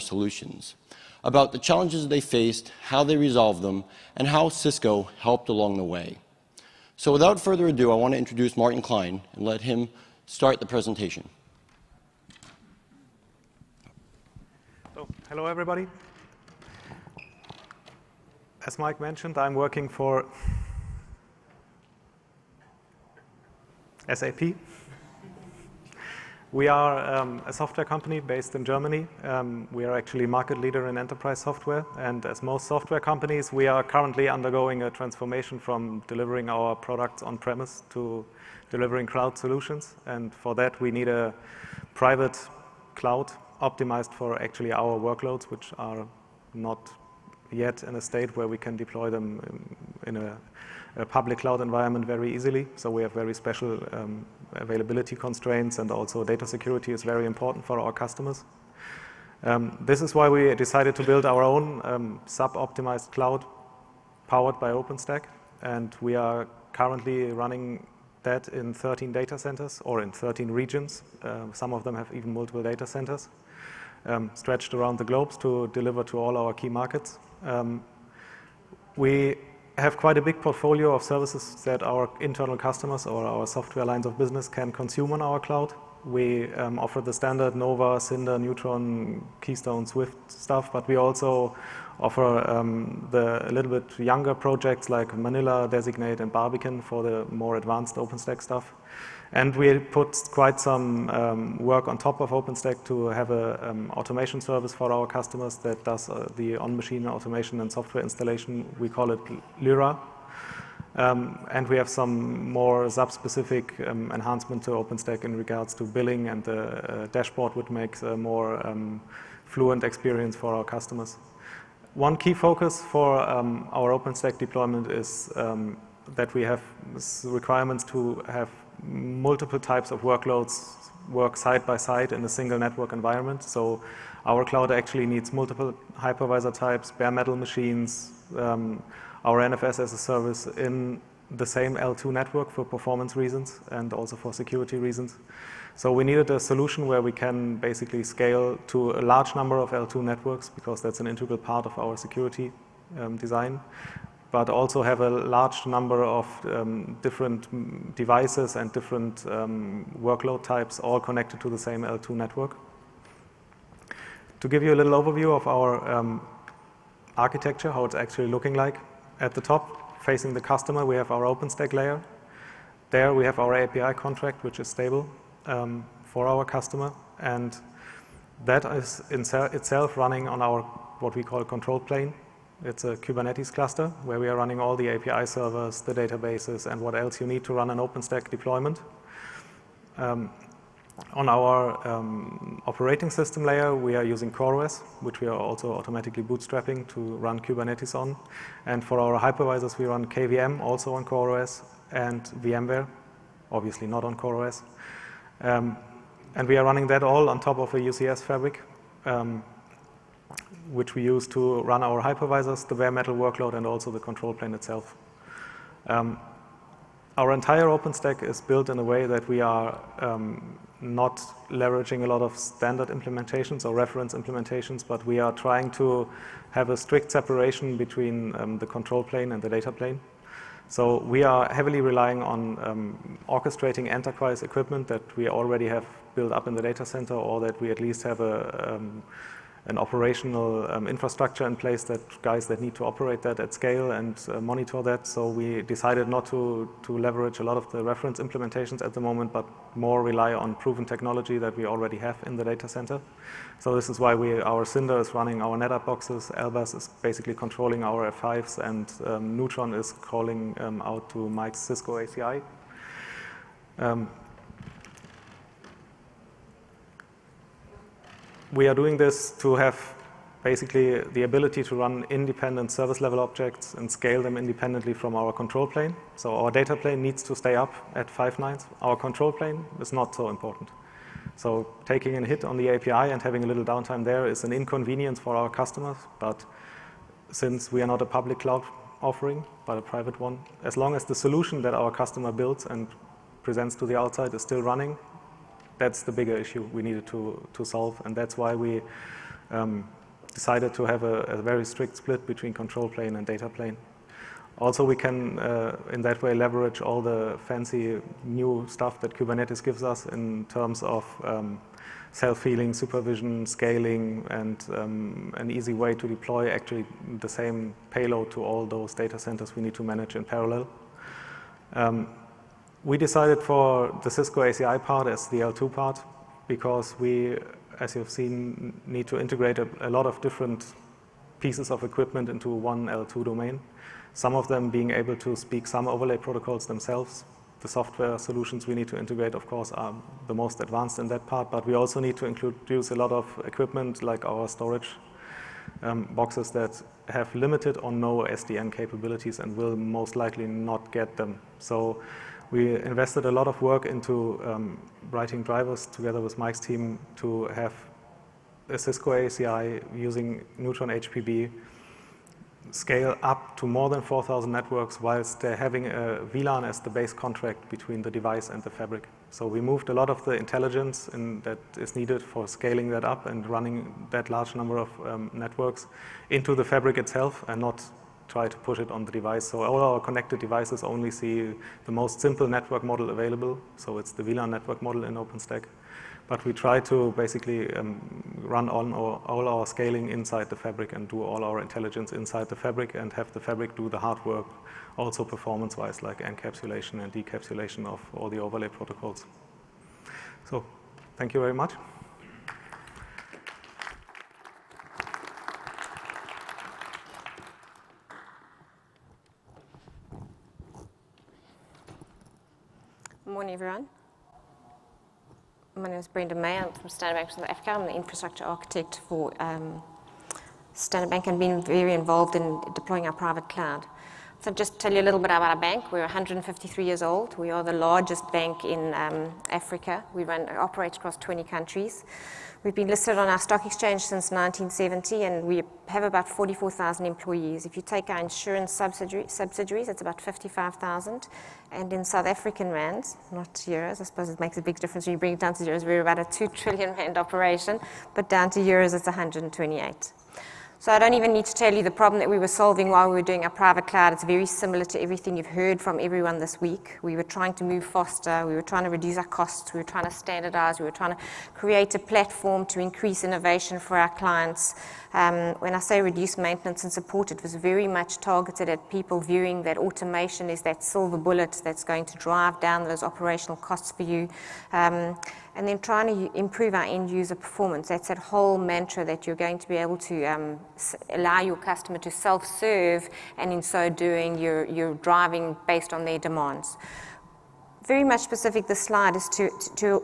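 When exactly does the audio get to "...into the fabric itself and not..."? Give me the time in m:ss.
6:16.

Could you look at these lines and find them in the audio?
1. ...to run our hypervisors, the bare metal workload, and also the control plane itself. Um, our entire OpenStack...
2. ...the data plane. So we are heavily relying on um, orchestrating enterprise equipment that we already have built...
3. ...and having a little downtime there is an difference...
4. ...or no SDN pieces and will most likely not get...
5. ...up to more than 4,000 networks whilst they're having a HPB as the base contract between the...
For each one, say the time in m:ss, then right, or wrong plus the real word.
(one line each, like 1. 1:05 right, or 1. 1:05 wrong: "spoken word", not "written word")
1. 3:31 right
2. 3:49 right
3. 4:43 wrong: "inconvenience", not "difference"
4. 5:47 wrong: "capabilities", not "pieces"
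5. 6:03 wrong: "VLAN", not "HPB".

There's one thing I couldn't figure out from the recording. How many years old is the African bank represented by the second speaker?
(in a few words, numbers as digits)
153.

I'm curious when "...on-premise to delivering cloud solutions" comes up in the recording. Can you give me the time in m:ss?
0:37.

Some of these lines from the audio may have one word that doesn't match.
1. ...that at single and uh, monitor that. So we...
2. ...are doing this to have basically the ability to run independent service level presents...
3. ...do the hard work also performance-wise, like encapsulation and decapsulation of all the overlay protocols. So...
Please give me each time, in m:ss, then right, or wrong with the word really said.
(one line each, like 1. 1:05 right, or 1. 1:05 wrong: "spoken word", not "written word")
1. 4:03 wrong: "scale", not "single"
2. 4:28 wrong: "objects", not "presents"
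3. 6:33 right.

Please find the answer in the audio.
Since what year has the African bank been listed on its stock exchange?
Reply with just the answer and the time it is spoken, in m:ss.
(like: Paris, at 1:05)
1970, at 7:14.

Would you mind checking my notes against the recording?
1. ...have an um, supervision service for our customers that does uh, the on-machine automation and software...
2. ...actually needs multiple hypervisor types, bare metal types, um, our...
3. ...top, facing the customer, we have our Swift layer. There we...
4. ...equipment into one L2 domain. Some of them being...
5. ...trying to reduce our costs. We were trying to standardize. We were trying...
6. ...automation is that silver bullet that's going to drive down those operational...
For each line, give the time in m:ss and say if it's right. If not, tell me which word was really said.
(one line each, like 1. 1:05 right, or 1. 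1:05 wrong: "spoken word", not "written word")
1. 1:43 wrong: "automation", not "supervision"
2. 2:14 wrong: "machines", not "types"
3. 2:49 wrong: "OpenStack", not "Swift"
4. 5:31 right
5. 7:38 right
6. 7:49 right.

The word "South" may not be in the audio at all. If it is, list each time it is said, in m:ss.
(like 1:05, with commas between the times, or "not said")
6:57, 7:22.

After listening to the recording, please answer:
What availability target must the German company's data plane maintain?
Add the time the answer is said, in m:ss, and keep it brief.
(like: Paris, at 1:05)
five nines, at 4:38.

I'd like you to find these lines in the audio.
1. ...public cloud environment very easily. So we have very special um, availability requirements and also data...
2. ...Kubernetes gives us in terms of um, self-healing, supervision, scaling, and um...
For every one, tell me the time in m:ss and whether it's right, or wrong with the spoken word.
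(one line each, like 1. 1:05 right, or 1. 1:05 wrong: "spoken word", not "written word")
1. 0:51 wrong: "constraints", not "requirements"
2. 5:09 right.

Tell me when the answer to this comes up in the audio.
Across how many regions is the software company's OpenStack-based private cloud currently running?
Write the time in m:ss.
1:10.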